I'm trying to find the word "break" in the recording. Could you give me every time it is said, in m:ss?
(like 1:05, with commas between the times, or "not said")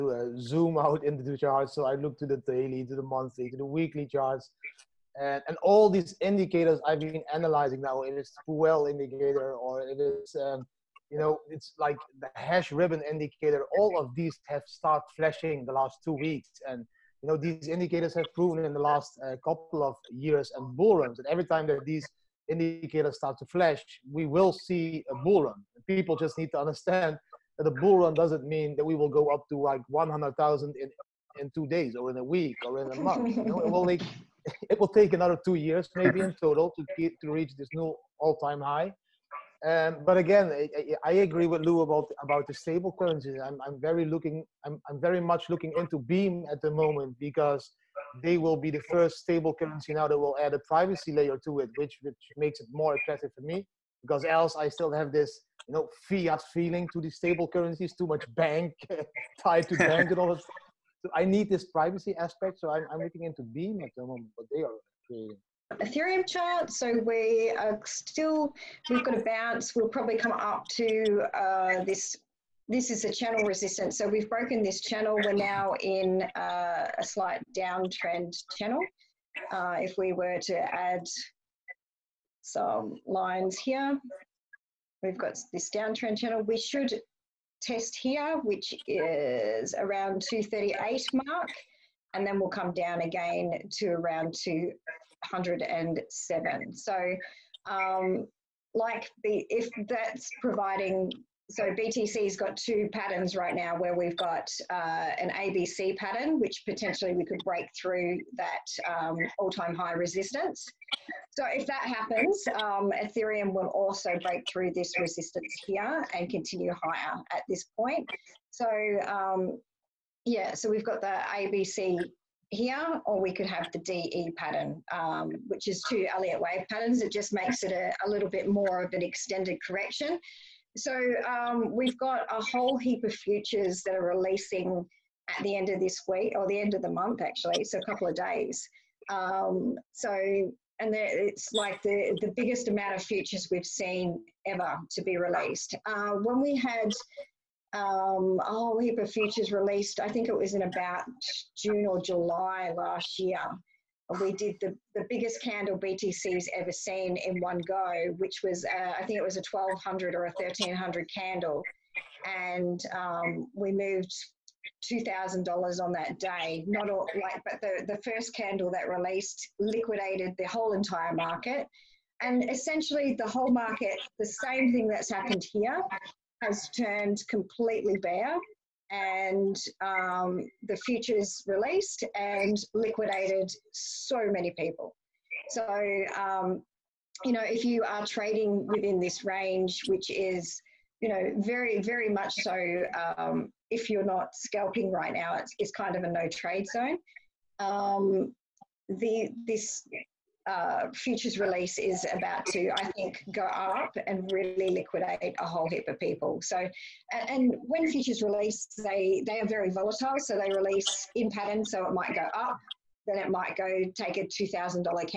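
1:47, 1:54.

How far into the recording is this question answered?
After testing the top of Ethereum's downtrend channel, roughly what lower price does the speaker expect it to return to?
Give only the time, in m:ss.
1:34.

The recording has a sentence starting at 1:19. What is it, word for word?
Uh, if we were to add some lines here, we've got this downtrend channel.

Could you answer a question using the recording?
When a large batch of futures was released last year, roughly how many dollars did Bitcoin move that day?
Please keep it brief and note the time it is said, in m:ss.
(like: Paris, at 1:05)
$2,000, at 2:44.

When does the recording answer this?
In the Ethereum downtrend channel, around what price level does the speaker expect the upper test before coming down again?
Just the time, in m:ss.
1:30.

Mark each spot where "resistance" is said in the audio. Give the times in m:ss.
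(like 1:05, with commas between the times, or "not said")
1:13, 1:49, 1:54.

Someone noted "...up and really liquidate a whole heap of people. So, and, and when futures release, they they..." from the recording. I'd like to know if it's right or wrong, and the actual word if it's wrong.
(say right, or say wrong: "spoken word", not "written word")
right.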